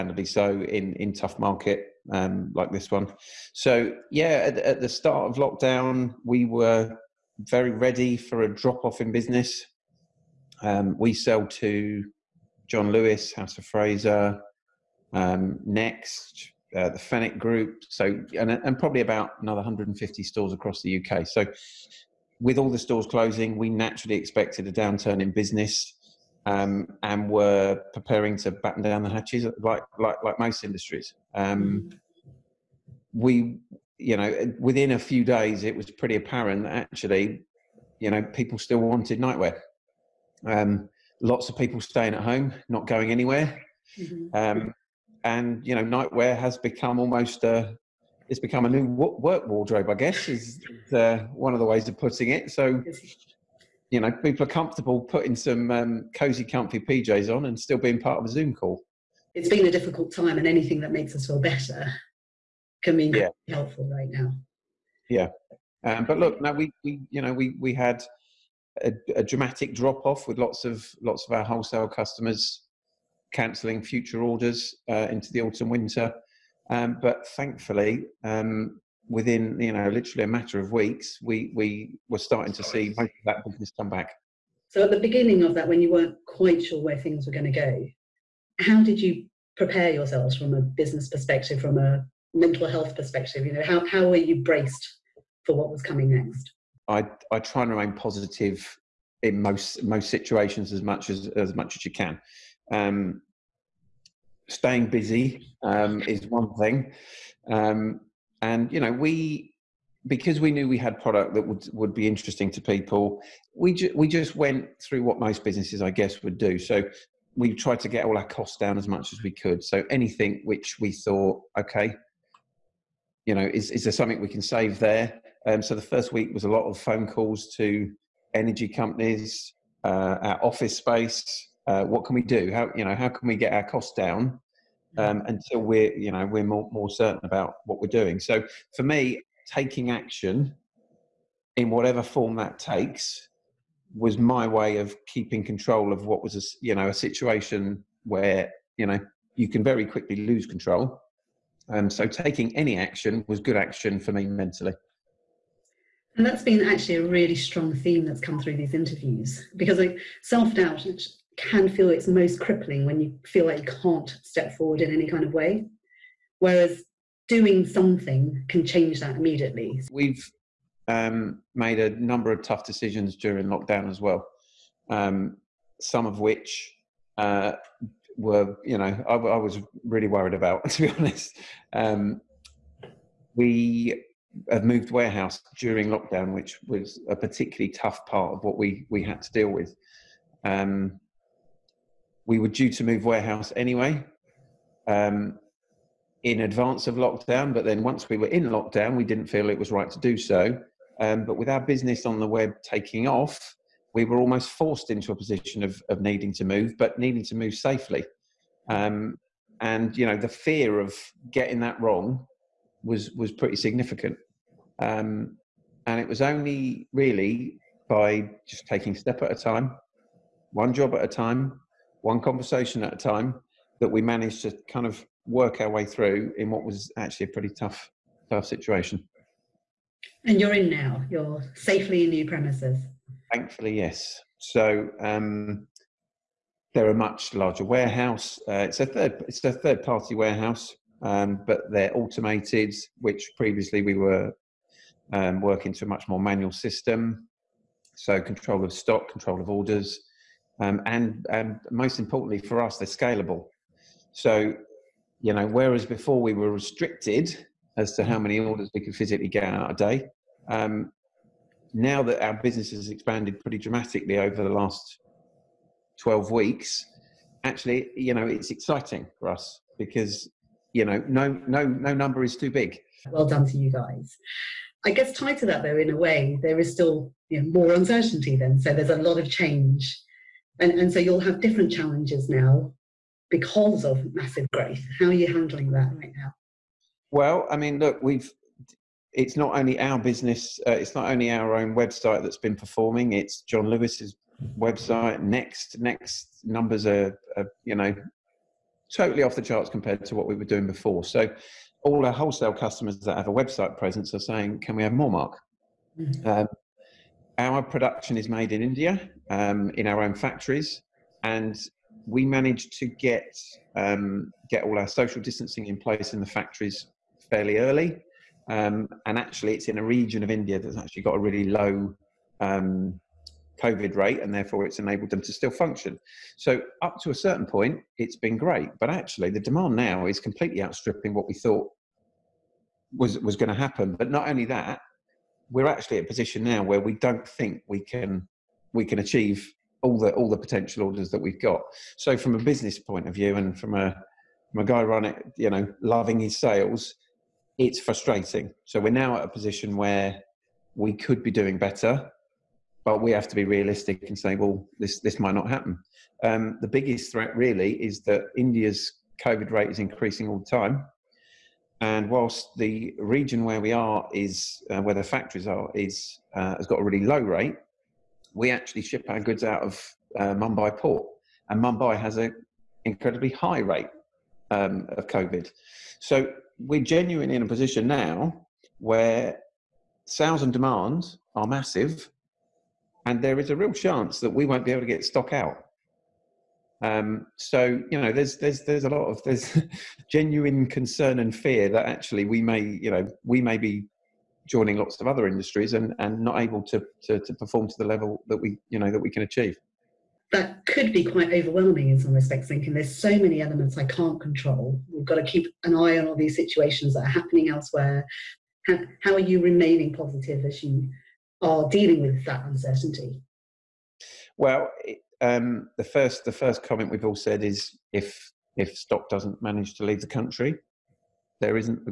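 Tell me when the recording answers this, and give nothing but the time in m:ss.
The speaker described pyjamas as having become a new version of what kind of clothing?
0:48.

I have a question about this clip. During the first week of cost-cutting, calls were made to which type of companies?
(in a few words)
energy companies.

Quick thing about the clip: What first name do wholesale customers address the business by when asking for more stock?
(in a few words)
Mark.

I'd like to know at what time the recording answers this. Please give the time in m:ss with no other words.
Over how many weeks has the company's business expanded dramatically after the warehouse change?
4:24.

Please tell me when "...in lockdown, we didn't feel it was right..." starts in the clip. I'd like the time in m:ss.
3:18.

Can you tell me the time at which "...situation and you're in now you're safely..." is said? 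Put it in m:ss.
3:48.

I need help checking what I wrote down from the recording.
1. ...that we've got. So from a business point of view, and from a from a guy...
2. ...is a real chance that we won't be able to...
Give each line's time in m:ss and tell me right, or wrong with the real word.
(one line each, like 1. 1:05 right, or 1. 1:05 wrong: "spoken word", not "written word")
1. 5:41 right
2. 6:23 right.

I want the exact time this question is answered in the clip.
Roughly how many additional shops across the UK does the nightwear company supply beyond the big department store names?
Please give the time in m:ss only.
0:19.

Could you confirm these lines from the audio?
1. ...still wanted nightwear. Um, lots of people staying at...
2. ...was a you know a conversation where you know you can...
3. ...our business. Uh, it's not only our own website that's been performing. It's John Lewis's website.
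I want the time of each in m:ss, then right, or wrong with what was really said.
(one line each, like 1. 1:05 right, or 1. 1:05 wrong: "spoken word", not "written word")
1. 0:38 right
2. 2:26 wrong: "situation", not "conversation"
3. 4:49 right.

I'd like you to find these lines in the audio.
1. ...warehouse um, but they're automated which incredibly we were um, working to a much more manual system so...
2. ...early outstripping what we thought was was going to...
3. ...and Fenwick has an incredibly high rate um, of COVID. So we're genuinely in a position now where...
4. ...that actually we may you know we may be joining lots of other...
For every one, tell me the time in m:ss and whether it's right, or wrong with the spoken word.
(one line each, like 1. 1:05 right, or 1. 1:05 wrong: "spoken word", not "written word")
1. 4:00 wrong: "previously", not "incredibly"
2. 5:30 wrong: "completely", not "early"
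3. 6:11 wrong: "Mumbai", not "Fenwick"
4. 6:31 right.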